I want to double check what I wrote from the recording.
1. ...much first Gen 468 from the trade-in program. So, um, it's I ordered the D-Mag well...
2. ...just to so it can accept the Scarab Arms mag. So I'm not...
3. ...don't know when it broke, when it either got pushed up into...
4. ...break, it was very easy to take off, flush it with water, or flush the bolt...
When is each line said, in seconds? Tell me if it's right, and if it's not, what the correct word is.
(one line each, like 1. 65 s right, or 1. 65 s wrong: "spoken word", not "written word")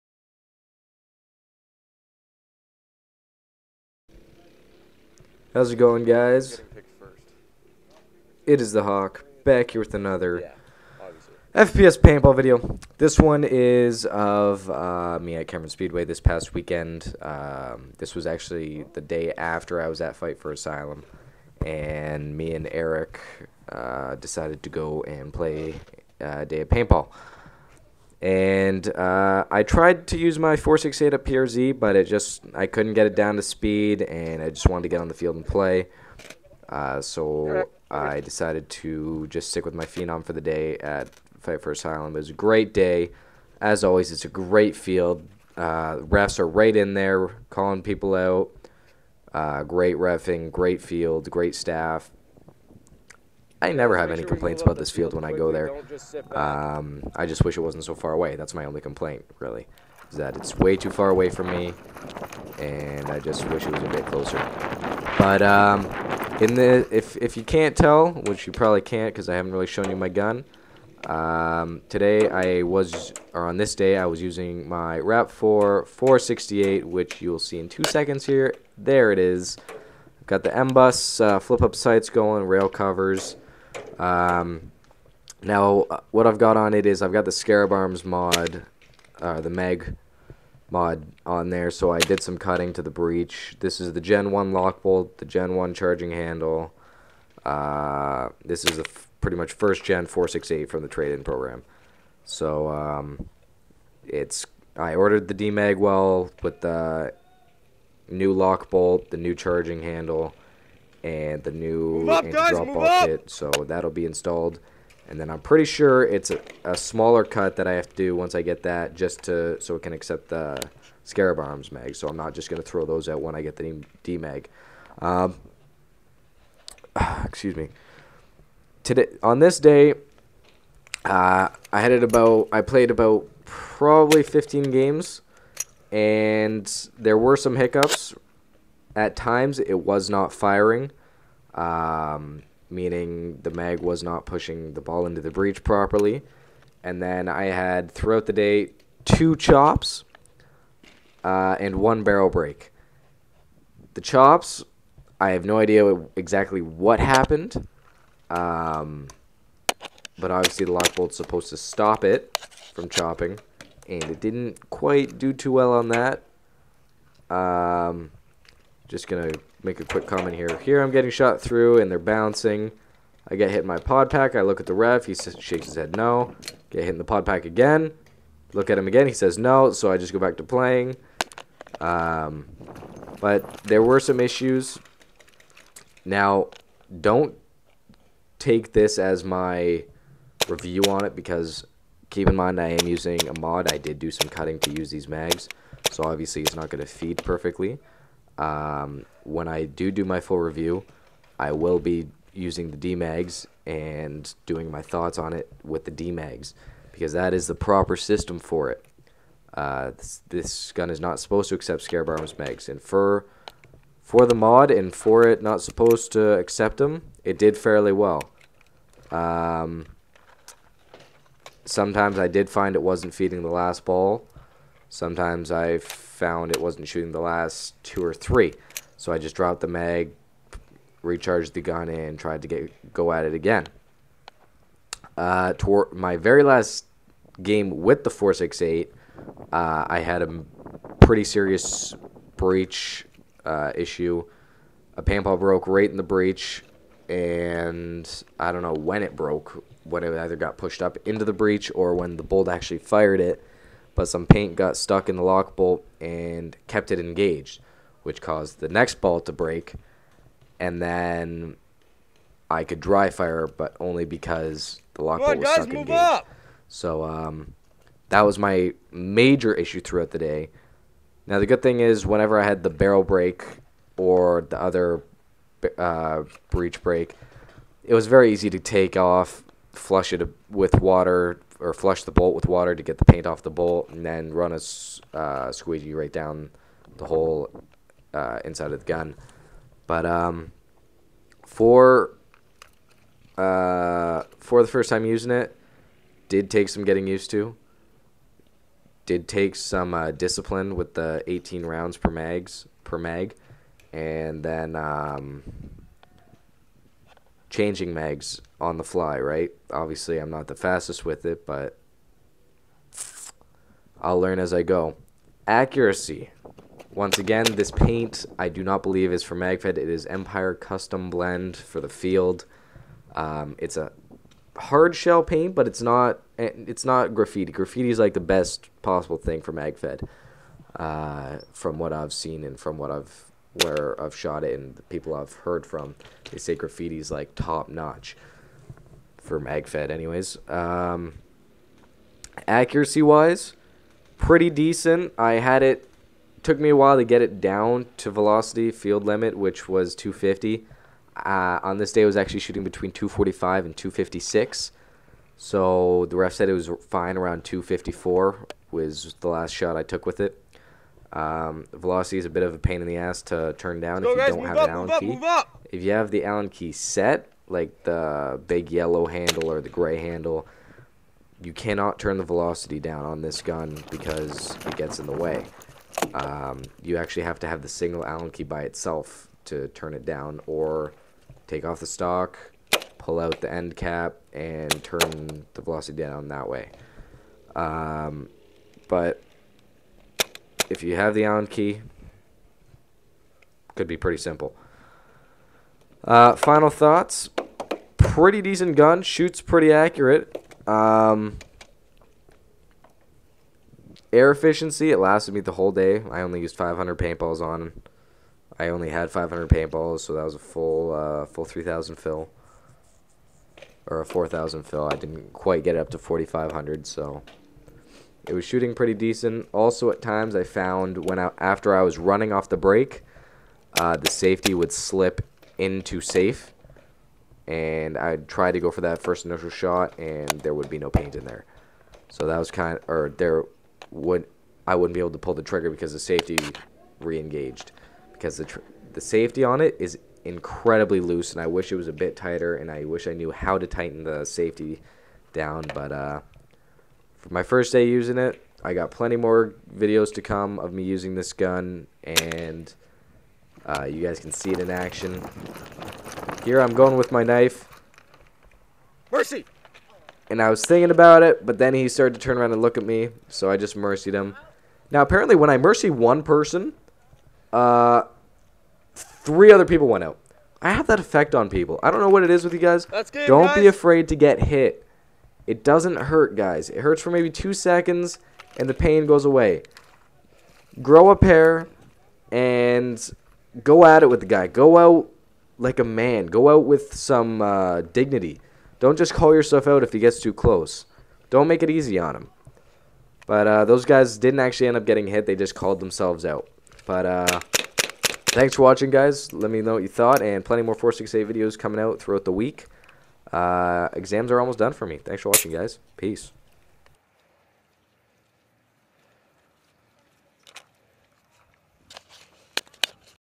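1. 99 s right
2. 118 s right
3. 248 s right
4. 276 s right.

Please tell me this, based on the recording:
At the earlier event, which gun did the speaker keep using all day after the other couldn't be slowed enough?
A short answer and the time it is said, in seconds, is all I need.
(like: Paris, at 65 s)
Phenom, at 39 s.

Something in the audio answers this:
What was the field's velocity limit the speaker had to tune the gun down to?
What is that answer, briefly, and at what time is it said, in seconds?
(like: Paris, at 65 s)
250, at 349 s.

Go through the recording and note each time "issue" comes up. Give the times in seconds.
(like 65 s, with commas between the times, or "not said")
184 s, 243 s, 269 s.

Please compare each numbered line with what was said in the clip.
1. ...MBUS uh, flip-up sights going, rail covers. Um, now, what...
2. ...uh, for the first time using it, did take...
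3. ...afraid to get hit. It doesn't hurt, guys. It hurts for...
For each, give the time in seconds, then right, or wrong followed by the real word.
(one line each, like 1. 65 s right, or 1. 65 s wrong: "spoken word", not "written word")
1. 80 s right
2. 293 s right
3. 473 s right.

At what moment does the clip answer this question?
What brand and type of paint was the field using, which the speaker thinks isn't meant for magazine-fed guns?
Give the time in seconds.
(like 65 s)
320 s.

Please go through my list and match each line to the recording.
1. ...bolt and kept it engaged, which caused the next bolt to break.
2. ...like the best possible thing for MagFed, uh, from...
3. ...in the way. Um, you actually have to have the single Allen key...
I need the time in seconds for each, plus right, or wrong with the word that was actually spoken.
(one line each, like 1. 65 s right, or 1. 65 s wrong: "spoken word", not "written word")
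1. 255 s right
2. 327 s right
3. 374 s right.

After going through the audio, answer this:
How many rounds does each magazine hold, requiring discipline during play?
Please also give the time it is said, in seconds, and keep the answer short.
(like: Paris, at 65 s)
18, at 301 s.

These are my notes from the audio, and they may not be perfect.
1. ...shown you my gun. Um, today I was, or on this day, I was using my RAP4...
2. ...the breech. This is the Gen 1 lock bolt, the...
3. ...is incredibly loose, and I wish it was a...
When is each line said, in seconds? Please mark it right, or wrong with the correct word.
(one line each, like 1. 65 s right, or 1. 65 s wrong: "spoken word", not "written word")
1. 69 s right
2. 92 s right
3. 439 s right.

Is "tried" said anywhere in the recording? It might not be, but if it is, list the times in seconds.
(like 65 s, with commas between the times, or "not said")
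29 s, 232 s.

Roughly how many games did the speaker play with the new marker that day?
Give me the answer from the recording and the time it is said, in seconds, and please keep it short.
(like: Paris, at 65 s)
15, at 134 s.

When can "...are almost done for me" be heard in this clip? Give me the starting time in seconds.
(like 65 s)
504 s.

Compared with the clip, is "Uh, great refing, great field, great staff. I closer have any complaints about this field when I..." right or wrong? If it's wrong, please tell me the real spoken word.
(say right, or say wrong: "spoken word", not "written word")
wrong: "never", not "closer".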